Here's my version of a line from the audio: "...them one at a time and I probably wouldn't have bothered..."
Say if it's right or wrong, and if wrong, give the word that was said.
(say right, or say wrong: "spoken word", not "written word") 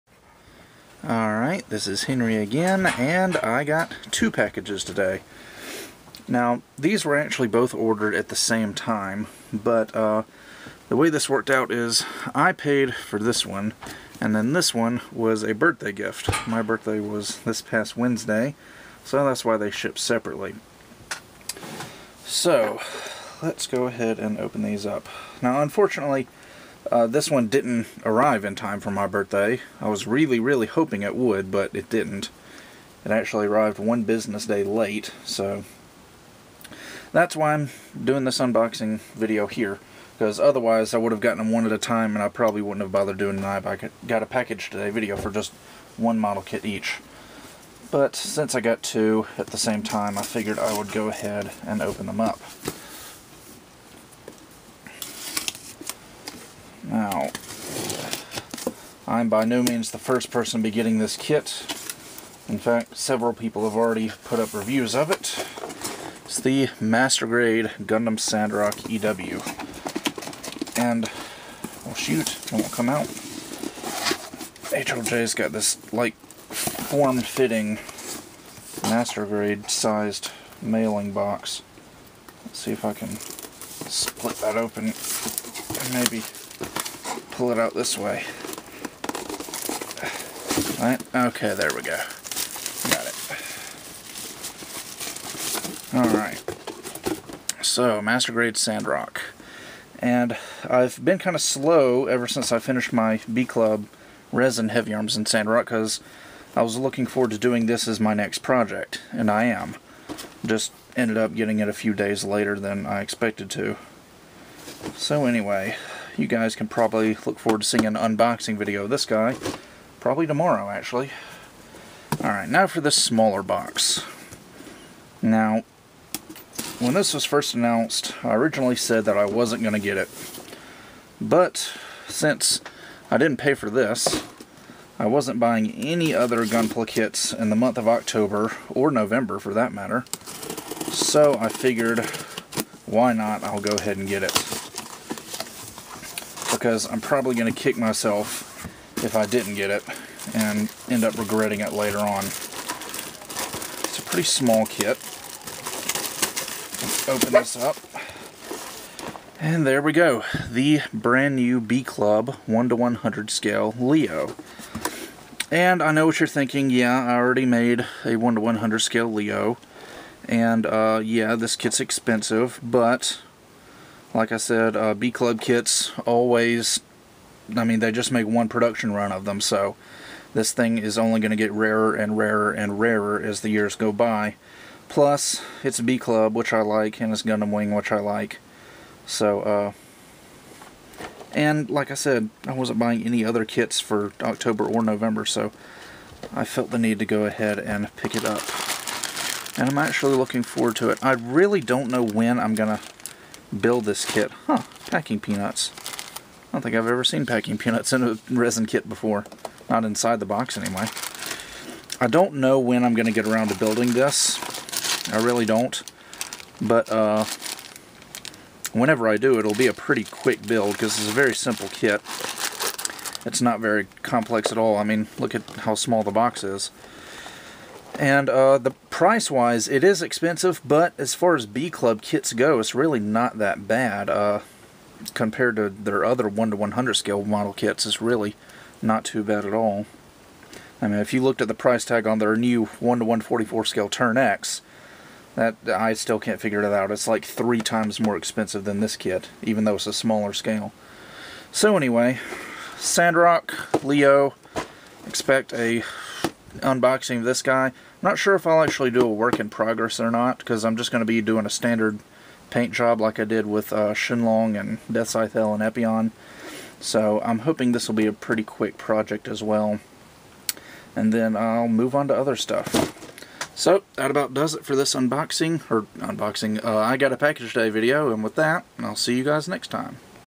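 right.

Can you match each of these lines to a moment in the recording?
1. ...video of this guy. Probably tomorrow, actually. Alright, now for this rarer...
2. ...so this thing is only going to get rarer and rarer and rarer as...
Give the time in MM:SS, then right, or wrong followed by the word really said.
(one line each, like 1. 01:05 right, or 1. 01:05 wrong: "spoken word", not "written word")
1. 01:58 wrong: "smaller", not "rarer"
2. 02:59 right.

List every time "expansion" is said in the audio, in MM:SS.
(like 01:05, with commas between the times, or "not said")
not said.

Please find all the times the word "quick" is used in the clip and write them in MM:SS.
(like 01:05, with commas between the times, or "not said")
03:40, 04:28.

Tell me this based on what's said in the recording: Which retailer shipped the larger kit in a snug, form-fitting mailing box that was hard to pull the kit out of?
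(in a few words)
HLJ.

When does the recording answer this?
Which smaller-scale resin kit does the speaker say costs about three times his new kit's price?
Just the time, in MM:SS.
04:03.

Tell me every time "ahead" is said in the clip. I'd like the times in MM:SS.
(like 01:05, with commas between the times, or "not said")
00:23, 00:51, 02:23, 03:17.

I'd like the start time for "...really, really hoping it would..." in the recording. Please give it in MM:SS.
00:30.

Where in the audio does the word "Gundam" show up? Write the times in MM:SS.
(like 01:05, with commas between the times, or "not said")
01:07, 03:07.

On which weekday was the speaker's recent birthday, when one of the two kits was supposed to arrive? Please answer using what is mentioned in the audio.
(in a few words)
Wednesday.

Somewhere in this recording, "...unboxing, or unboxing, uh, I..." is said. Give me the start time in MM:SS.
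04:34.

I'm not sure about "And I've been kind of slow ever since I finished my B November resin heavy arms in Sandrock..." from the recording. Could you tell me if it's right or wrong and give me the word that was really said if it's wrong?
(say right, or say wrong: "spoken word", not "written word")
wrong: "Club", not "November".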